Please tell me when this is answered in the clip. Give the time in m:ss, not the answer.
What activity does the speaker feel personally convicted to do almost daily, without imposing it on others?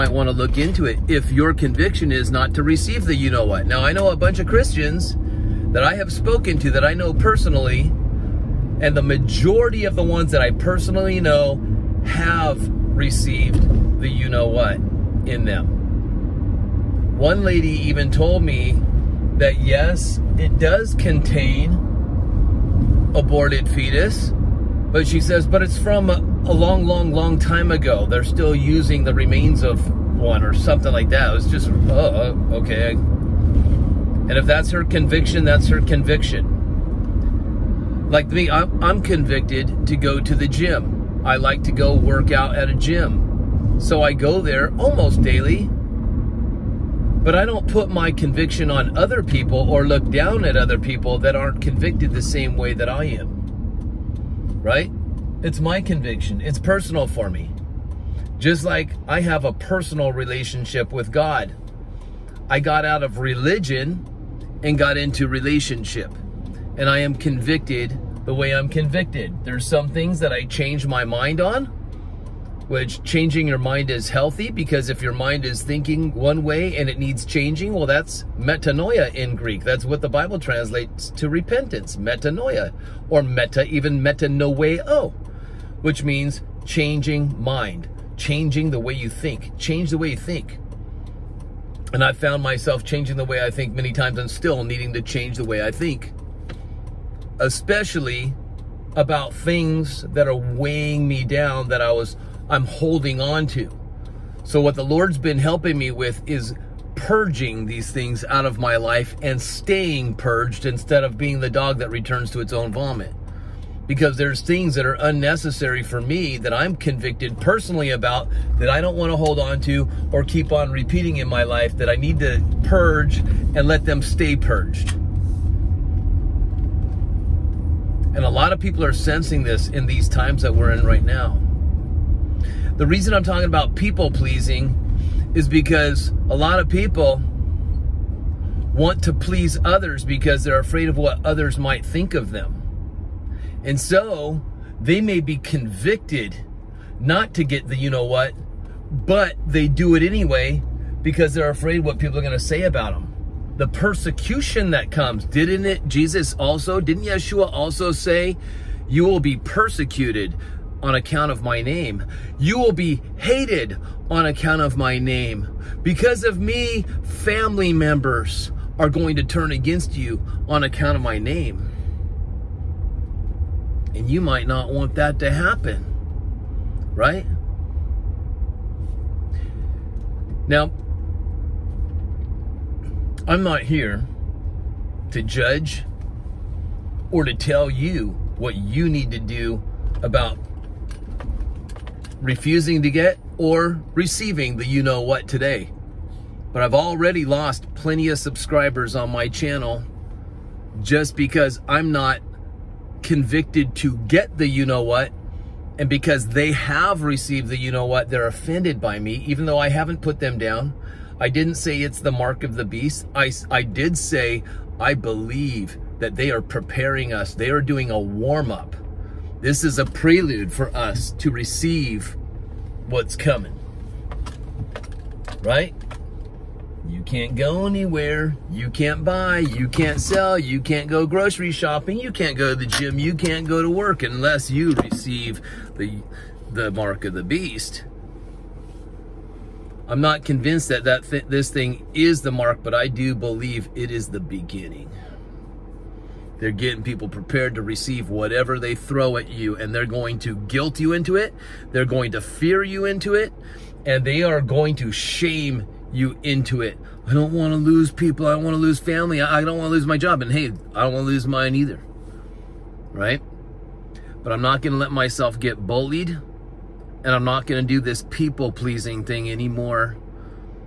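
0:41.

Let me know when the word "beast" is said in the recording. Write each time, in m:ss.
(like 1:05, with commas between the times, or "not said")
3:32, 3:57.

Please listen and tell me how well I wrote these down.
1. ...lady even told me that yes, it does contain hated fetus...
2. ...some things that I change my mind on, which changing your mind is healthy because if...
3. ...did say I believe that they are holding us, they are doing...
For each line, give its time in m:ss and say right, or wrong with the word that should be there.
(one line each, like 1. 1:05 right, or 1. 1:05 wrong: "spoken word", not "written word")
1. 0:17 wrong: "aborted", not "hated"
2. 1:09 right
3. 3:33 wrong: "preparing", not "holding".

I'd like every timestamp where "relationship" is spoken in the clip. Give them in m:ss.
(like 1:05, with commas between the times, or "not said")
1:00, 1:05.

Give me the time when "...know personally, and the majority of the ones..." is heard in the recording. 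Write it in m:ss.
0:06.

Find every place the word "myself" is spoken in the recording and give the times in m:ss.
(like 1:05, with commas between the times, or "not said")
1:32, 4:24.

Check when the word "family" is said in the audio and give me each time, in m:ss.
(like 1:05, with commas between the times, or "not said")
2:47, 4:18.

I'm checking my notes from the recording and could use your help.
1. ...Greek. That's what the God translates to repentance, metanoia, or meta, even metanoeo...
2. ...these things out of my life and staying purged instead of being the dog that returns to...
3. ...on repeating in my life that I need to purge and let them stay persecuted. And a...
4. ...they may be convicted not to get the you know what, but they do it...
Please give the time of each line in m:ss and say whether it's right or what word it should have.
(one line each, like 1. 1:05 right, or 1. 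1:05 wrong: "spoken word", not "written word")
1. 1:19 wrong: "Bible", not "God"
2. 1:47 right
3. 2:00 wrong: "purged", not "persecuted"
4. 2:24 right.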